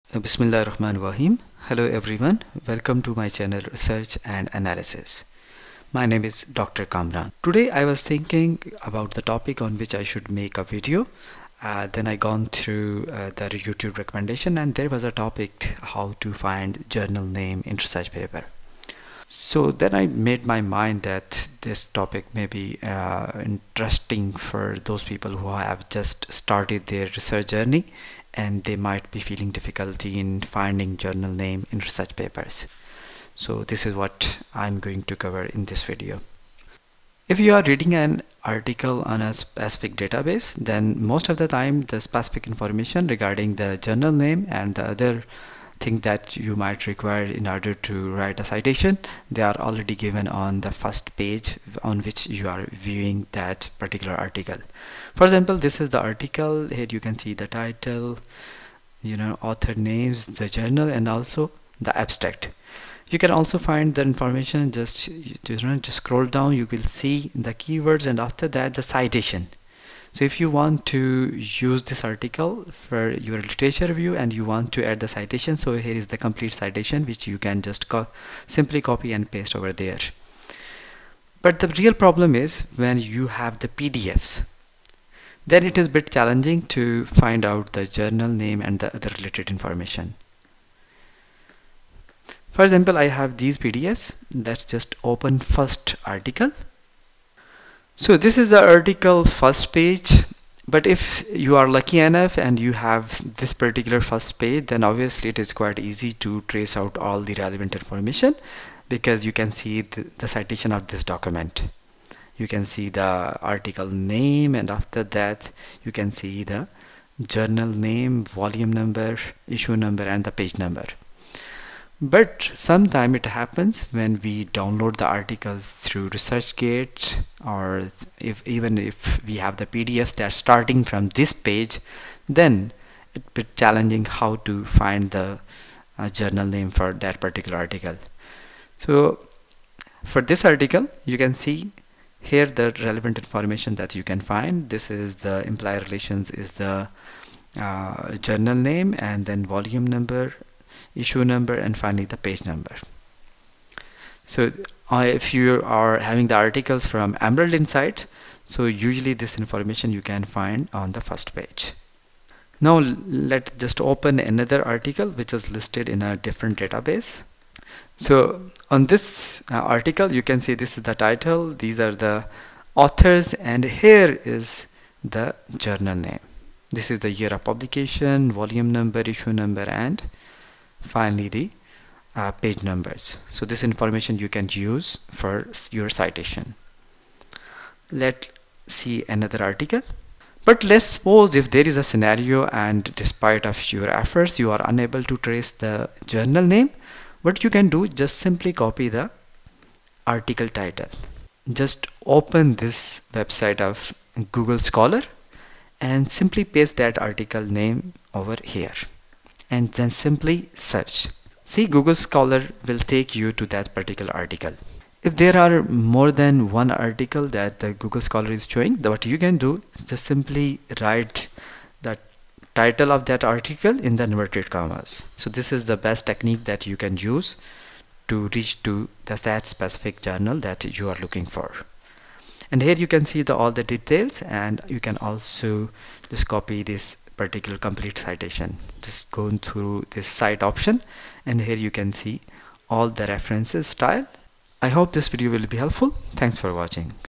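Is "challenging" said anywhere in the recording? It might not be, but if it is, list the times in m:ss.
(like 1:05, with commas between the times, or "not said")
1:26, 2:13.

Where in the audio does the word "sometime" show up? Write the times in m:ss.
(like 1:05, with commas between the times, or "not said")
2:02.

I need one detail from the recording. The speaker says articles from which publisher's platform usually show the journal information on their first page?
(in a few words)
Emerald Insights.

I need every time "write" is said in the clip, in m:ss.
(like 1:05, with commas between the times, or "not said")
0:48, 3:40.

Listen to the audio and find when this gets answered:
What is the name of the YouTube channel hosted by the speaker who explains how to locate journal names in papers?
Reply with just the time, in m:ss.
0:03.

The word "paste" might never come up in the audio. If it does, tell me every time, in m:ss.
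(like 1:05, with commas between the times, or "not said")
1:19, 3:26.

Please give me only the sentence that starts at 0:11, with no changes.
Uh, then I gone through uh, the YouTube recommendation and there was a topic how to find journal name in research paper.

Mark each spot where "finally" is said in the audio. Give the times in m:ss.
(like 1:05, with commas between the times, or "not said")
2:31, 3:00.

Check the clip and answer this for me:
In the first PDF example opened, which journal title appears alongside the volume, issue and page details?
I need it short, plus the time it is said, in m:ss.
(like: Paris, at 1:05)
Employee Relations, at 2:25.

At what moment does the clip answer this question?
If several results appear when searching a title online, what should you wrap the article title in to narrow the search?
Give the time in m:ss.
3:44.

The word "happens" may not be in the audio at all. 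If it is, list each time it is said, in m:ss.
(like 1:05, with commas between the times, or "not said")
2:03.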